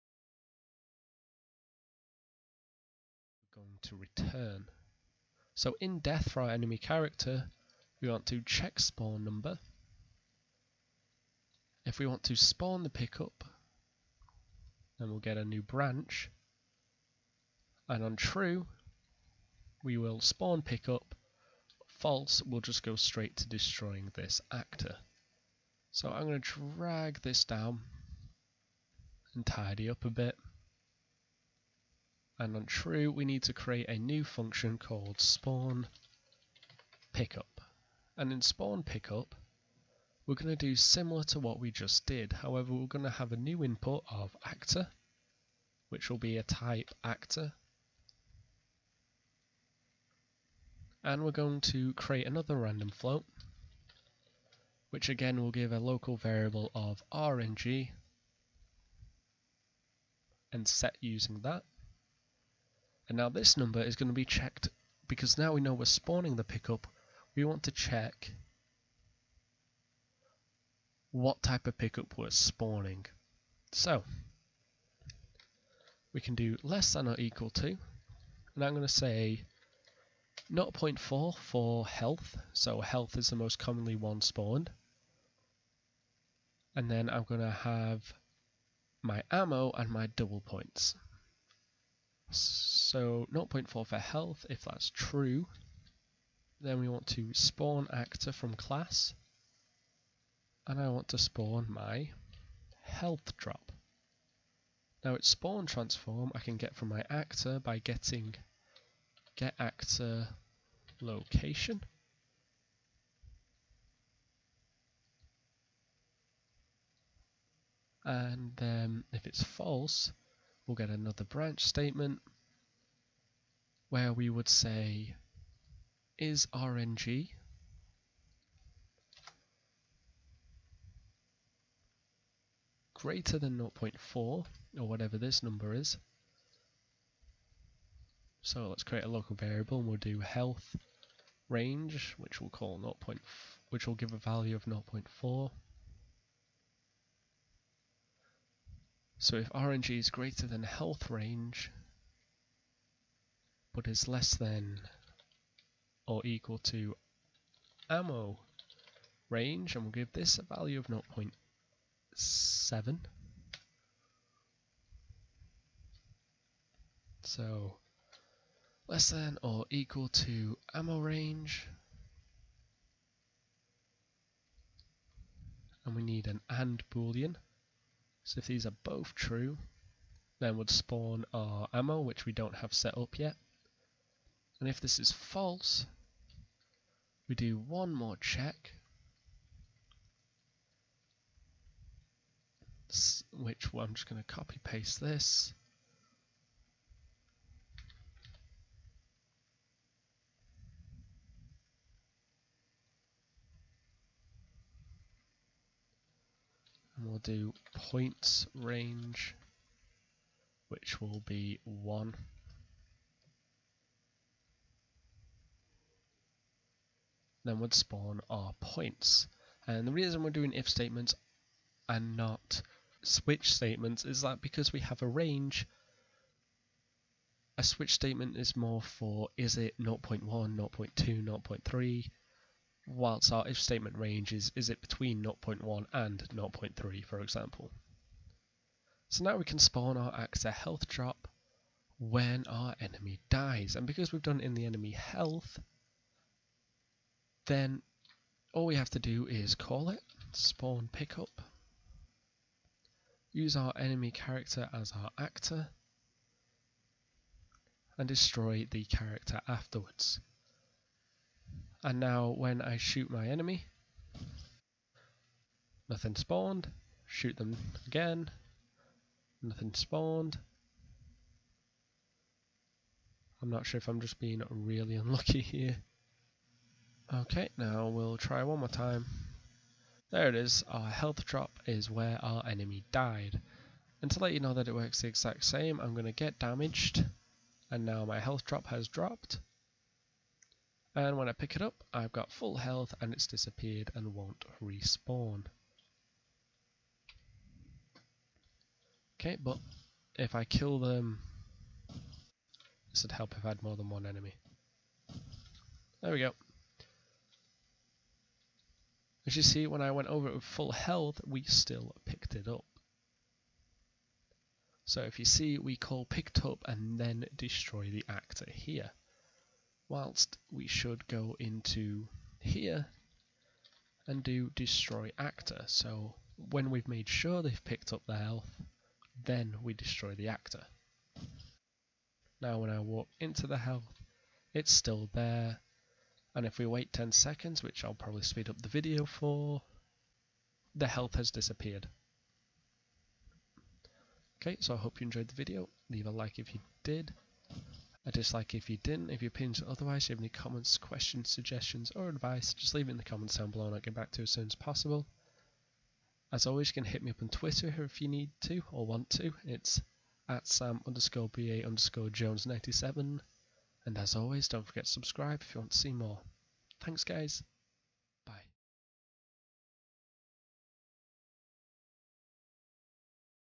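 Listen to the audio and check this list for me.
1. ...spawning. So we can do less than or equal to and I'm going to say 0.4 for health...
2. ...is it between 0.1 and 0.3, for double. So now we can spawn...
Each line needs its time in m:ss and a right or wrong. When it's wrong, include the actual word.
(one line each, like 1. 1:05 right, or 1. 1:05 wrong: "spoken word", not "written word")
1. 1:12 right
2. 3:54 wrong: "example", not "double".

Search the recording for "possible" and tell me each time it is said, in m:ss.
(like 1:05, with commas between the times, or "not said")
5:54.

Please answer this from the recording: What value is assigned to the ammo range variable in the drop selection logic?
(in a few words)
0.7.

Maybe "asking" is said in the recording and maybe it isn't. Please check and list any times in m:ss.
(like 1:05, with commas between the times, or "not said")
not said.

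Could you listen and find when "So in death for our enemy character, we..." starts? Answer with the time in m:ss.
0:05.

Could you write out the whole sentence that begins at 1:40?
And I want to spawn my health drop.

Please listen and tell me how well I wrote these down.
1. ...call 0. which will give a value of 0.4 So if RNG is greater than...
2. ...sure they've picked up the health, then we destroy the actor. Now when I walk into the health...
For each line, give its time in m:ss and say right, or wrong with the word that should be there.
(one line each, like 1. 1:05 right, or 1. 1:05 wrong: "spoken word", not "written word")
1. 2:22 right
2. 5:27 right.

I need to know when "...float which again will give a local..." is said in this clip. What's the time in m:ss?
0:52.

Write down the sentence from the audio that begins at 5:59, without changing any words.
It's at sam underscore ba underscore jones 97.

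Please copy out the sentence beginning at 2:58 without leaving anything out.
So if these are both true, then would spawn our ammo, which we don't have set up yet.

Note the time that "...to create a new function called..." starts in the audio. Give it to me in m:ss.
0:33.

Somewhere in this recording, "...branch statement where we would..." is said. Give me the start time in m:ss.
2:01.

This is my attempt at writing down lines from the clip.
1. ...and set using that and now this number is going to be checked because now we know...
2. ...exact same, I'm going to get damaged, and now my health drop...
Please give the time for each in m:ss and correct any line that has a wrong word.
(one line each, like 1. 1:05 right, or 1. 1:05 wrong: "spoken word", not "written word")
1. 1:00 right
2. 4:45 right.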